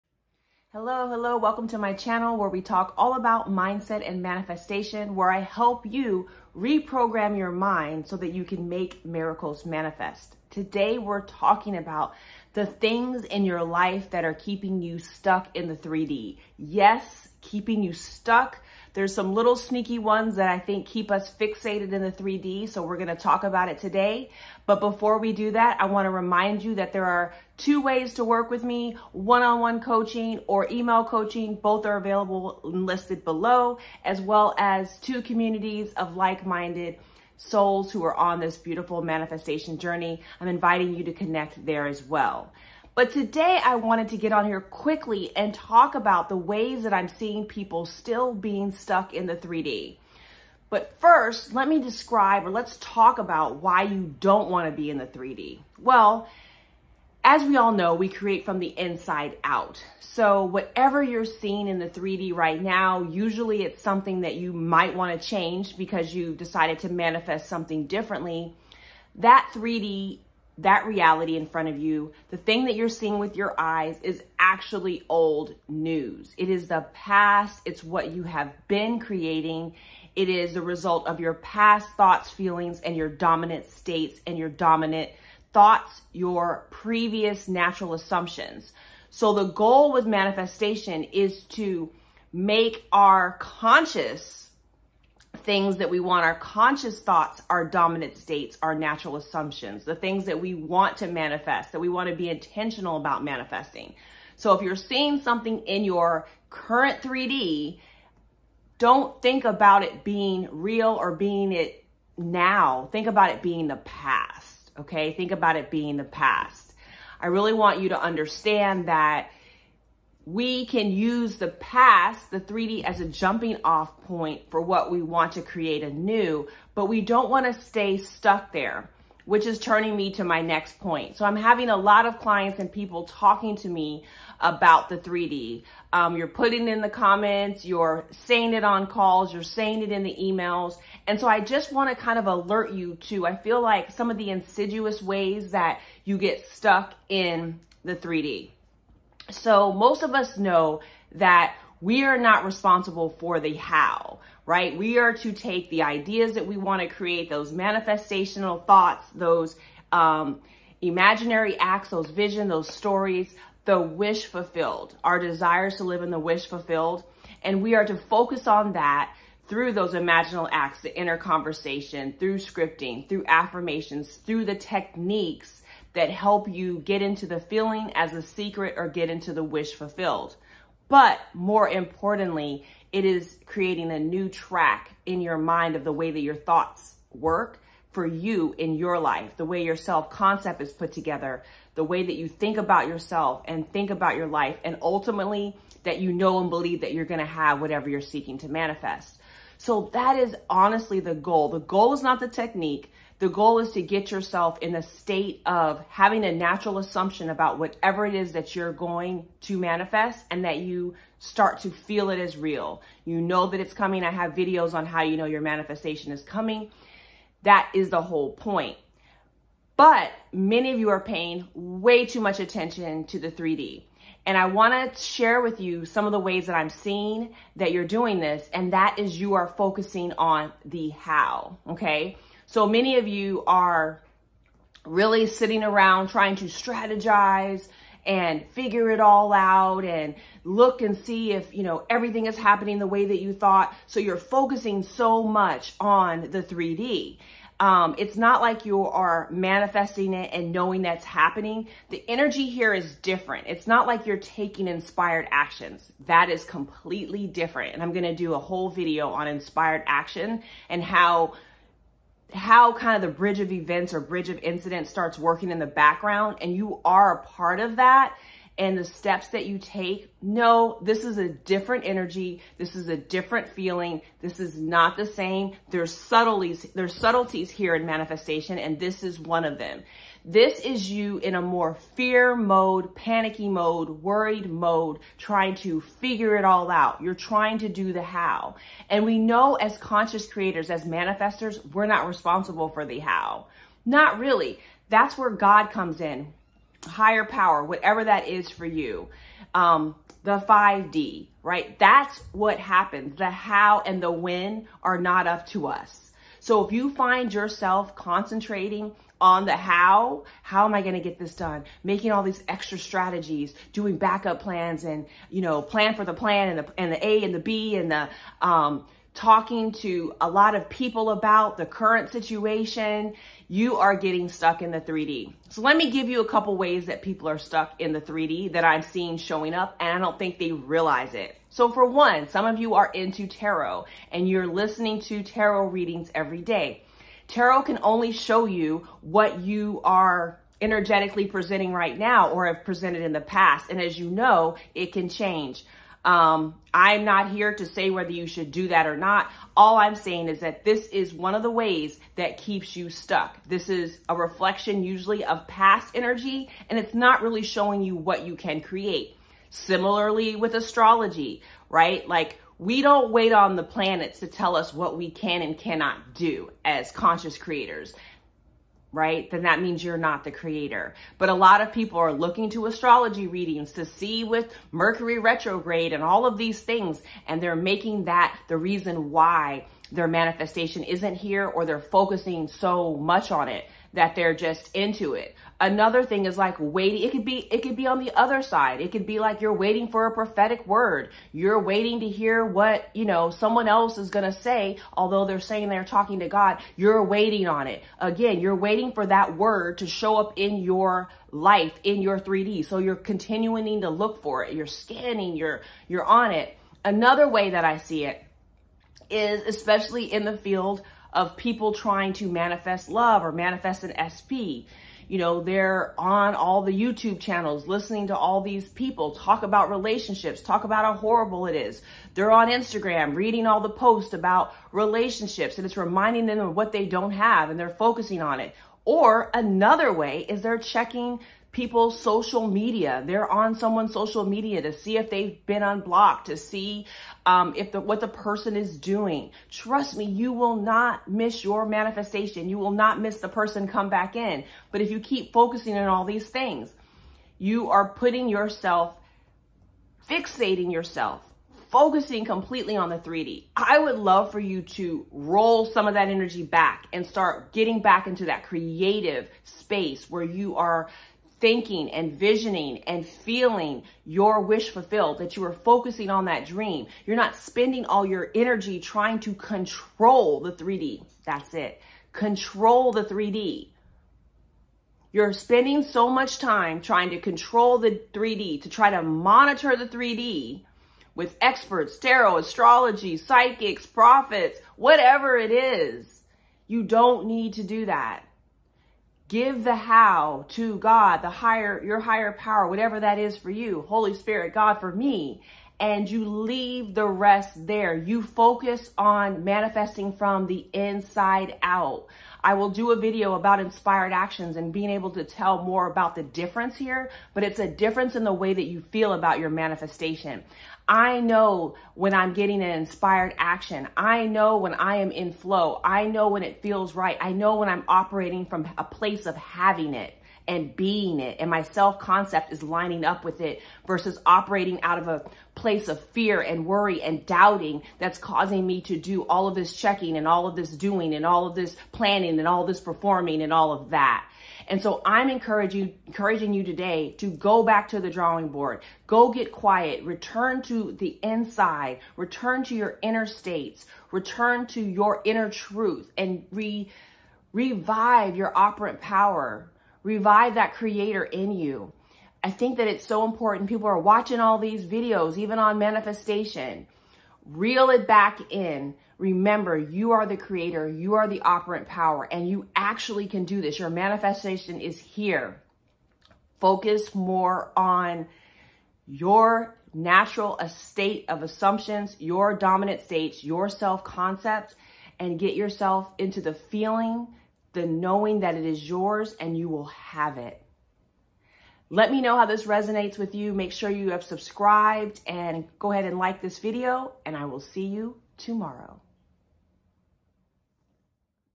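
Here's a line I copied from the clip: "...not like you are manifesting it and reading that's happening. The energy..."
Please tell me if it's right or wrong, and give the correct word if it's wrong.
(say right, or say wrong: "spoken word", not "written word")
wrong: "knowing", not "reading".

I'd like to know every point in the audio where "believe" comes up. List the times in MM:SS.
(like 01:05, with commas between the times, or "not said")
03:16.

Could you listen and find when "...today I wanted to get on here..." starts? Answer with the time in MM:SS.
00:43.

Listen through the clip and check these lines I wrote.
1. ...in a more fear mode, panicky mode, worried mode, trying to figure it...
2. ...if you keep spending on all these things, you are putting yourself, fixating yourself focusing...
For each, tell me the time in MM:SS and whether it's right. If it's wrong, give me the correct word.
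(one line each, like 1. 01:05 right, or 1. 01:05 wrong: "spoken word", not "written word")
1. 04:41 right
2. 07:24 wrong: "focusing", not "spending".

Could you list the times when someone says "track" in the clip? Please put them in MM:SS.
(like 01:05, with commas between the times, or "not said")
03:04.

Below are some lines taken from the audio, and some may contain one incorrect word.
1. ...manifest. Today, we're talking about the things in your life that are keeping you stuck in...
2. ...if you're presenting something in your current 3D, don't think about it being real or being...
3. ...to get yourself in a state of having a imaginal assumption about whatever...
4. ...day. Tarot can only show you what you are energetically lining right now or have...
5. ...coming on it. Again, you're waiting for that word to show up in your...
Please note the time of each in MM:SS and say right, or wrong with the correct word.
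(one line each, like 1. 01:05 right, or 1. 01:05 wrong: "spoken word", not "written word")
1. 00:09 right
2. 01:44 wrong: "seeing", not "presenting"
3. 03:23 wrong: "natural", not "imaginal"
4. 05:36 wrong: "presenting", not "lining"
5. 06:37 wrong: "waiting", not "coming".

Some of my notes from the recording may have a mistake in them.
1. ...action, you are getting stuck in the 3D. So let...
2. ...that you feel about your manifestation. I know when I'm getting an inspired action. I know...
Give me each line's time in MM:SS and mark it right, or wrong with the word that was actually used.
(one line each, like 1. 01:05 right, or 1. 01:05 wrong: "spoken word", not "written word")
1. 05:22 wrong: "situation", not "action"
2. 08:28 right.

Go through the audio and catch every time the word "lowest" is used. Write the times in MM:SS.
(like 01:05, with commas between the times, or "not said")
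not said.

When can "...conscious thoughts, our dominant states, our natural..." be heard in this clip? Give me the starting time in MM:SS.
01:36.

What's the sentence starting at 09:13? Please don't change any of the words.
People are watching all these videos, even on manifestation reel it back in.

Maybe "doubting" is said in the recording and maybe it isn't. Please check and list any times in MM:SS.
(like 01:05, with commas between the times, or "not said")
08:47.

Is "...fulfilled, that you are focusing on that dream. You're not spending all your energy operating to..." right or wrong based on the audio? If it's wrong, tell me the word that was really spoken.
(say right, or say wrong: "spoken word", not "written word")
wrong: "trying", not "operating".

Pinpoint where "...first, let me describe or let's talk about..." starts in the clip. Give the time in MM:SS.
00:50.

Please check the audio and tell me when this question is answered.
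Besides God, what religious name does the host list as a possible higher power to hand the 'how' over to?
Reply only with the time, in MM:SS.
08:13.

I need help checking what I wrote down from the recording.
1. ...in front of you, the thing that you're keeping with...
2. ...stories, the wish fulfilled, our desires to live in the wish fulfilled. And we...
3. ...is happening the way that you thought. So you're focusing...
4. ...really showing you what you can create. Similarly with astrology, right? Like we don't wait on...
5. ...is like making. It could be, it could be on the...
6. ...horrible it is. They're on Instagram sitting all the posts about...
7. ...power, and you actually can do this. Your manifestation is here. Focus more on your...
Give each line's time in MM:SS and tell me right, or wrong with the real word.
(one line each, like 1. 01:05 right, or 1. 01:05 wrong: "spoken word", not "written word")
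1. 01:11 wrong: "seeing", not "keeping"
2. 02:42 right
3. 04:02 right
4. 05:57 right
5. 06:26 wrong: "waiting", not "making"
6. 07:00 wrong: "reading", not "sitting"
7. 09:21 right.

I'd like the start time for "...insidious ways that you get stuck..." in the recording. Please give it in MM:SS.
02:24.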